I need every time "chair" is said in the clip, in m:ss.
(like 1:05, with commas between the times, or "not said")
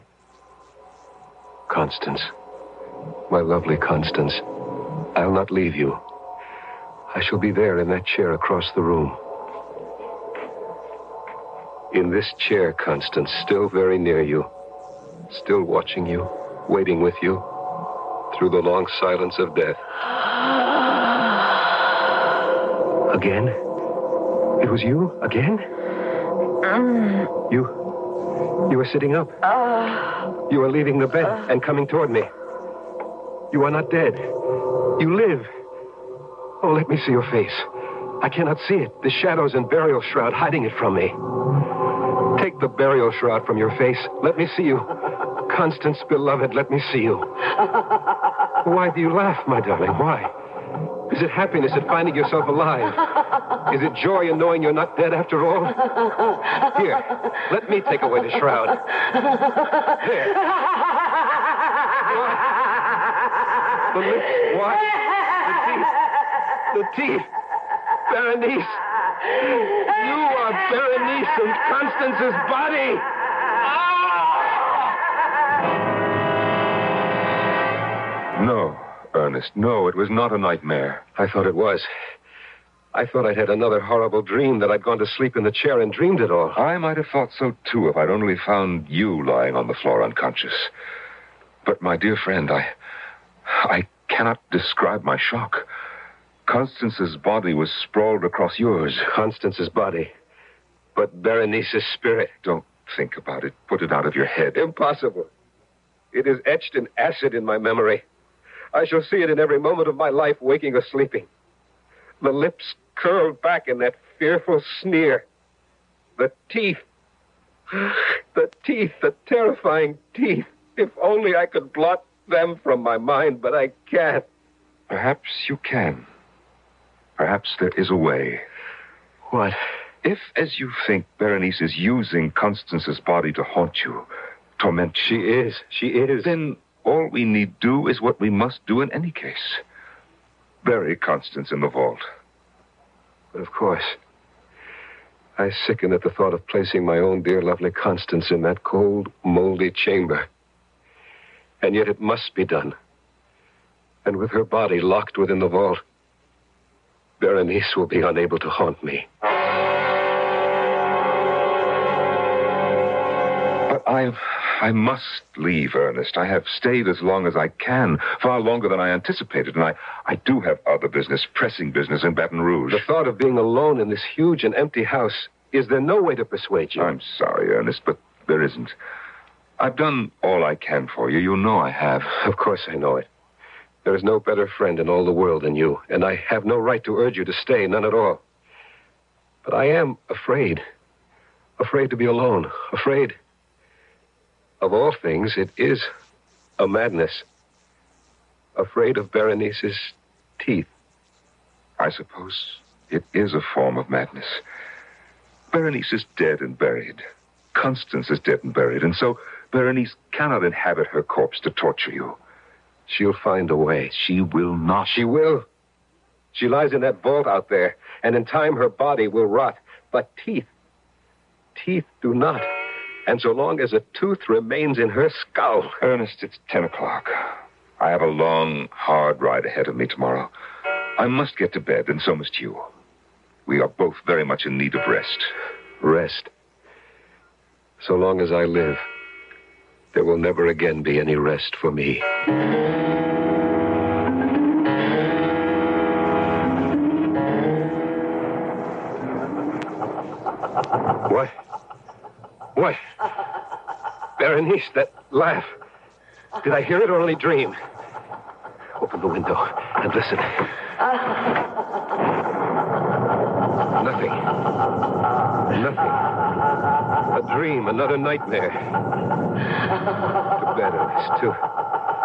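0:08, 0:12, 1:25.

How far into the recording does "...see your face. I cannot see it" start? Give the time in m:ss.
0:37.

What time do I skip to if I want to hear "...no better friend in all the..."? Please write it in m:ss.
3:04.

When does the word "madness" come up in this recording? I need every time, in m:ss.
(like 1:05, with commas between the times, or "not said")
3:16, 3:23.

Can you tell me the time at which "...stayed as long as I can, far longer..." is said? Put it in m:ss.
2:46.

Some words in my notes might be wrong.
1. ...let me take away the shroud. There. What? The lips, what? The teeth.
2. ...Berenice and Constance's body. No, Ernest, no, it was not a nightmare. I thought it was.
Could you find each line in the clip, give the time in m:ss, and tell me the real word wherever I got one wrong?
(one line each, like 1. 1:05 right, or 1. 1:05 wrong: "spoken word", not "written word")
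1. 0:57 right
2. 1:10 right.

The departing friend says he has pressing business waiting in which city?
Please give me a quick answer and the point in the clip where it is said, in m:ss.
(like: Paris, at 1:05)
Baton Rouge, at 2:52.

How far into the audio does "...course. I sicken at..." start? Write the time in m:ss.
2:23.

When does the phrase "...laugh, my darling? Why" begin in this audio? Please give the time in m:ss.
0:49.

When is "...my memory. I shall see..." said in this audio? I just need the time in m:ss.
1:47.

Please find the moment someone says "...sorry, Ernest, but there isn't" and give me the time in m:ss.
2:57.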